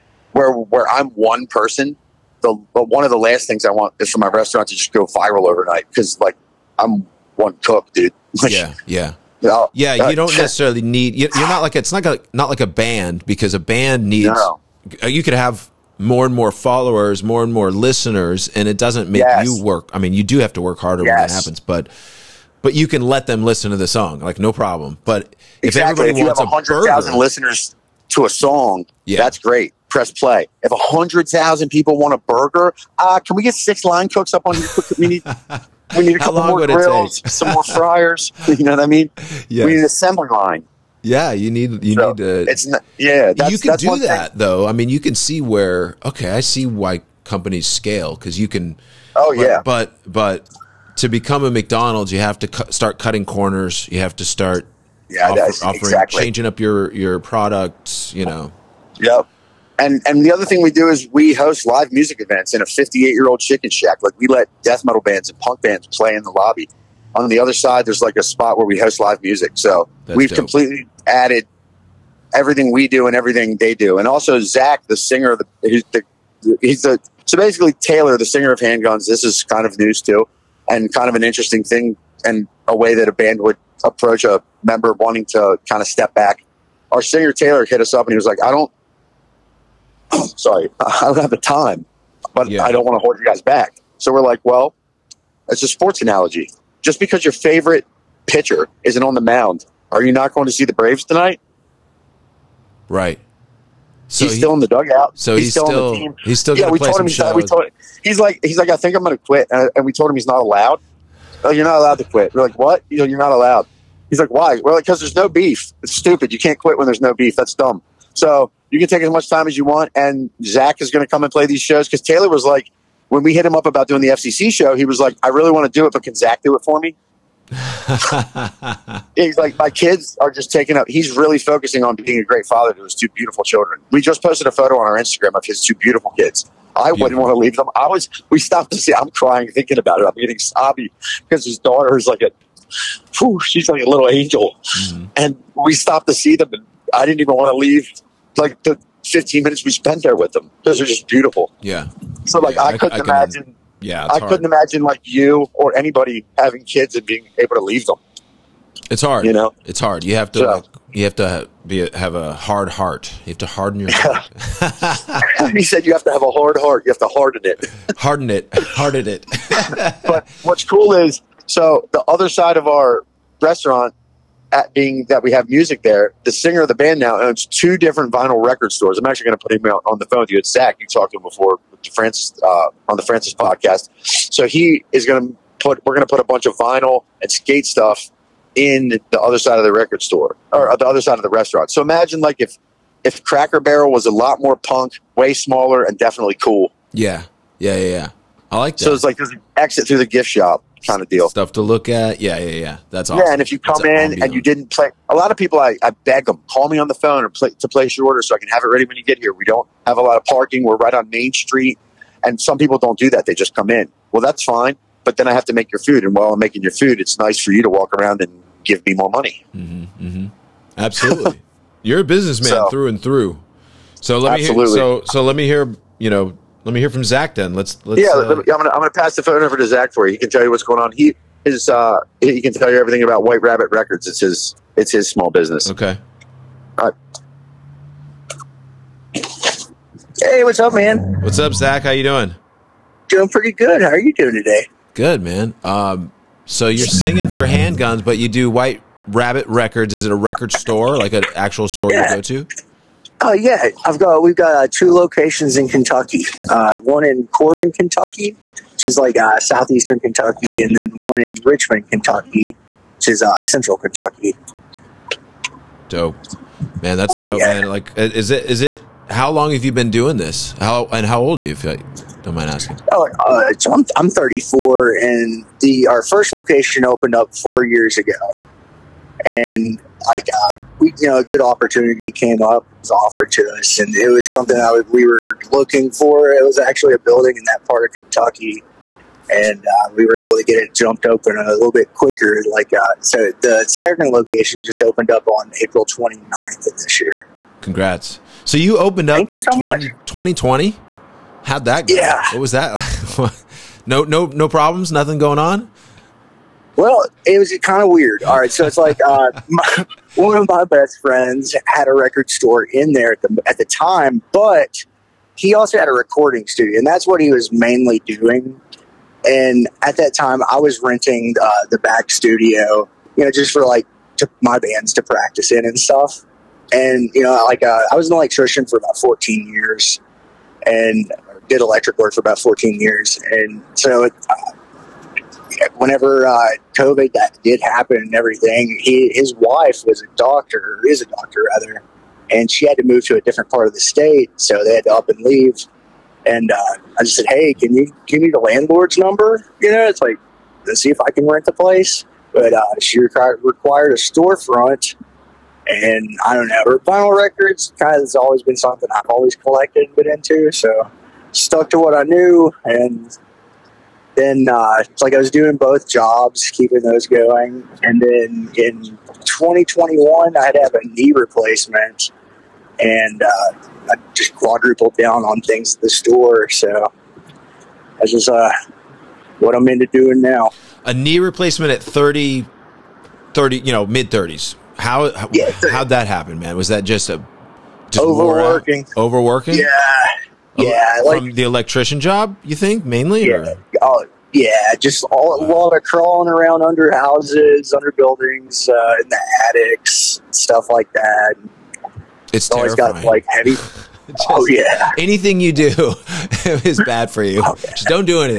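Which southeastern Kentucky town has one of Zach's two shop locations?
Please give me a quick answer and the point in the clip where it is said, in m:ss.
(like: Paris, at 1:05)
Corbin, at 4:17.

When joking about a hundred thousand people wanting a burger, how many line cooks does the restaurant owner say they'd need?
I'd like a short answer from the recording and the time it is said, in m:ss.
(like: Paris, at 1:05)
6, at 0:33.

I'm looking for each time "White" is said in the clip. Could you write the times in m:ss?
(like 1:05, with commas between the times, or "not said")
3:53, 4:08.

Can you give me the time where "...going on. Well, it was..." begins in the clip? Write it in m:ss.
5:05.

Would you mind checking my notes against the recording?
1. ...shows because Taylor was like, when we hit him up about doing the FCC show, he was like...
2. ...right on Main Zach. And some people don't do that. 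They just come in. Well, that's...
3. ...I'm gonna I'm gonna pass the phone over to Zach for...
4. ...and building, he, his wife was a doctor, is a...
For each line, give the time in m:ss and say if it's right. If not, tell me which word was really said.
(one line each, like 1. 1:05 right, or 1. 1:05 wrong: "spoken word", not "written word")
1. 2:01 right
2. 3:30 wrong: "Street", not "Zach"
3. 3:48 right
4. 5:37 wrong: "everything", not "building".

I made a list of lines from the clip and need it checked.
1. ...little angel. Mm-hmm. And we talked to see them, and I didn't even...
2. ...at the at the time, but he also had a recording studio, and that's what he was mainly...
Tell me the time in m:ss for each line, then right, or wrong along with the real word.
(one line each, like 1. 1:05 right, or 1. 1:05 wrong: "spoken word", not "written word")
1. 2:23 wrong: "stopped", not "talked"
2. 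5:13 right.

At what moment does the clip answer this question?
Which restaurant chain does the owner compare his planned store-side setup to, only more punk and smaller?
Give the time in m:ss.
3:13.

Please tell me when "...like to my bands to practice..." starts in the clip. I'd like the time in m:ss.
5:23.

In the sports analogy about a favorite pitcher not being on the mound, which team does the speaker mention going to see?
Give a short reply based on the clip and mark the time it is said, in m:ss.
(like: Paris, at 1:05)
Braves, at 1:40.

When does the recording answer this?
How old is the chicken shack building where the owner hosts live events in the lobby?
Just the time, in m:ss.
1:02.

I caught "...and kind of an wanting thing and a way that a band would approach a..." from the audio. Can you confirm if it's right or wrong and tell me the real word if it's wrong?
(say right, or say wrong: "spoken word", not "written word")
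wrong: "interesting", not "wanting".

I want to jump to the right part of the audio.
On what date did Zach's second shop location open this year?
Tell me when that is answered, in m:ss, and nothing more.
4:55.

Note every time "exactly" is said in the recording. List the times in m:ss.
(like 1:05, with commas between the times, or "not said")
0:25, 0:55.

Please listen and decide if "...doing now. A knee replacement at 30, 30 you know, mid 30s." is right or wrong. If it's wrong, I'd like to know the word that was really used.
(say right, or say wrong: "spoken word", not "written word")
right.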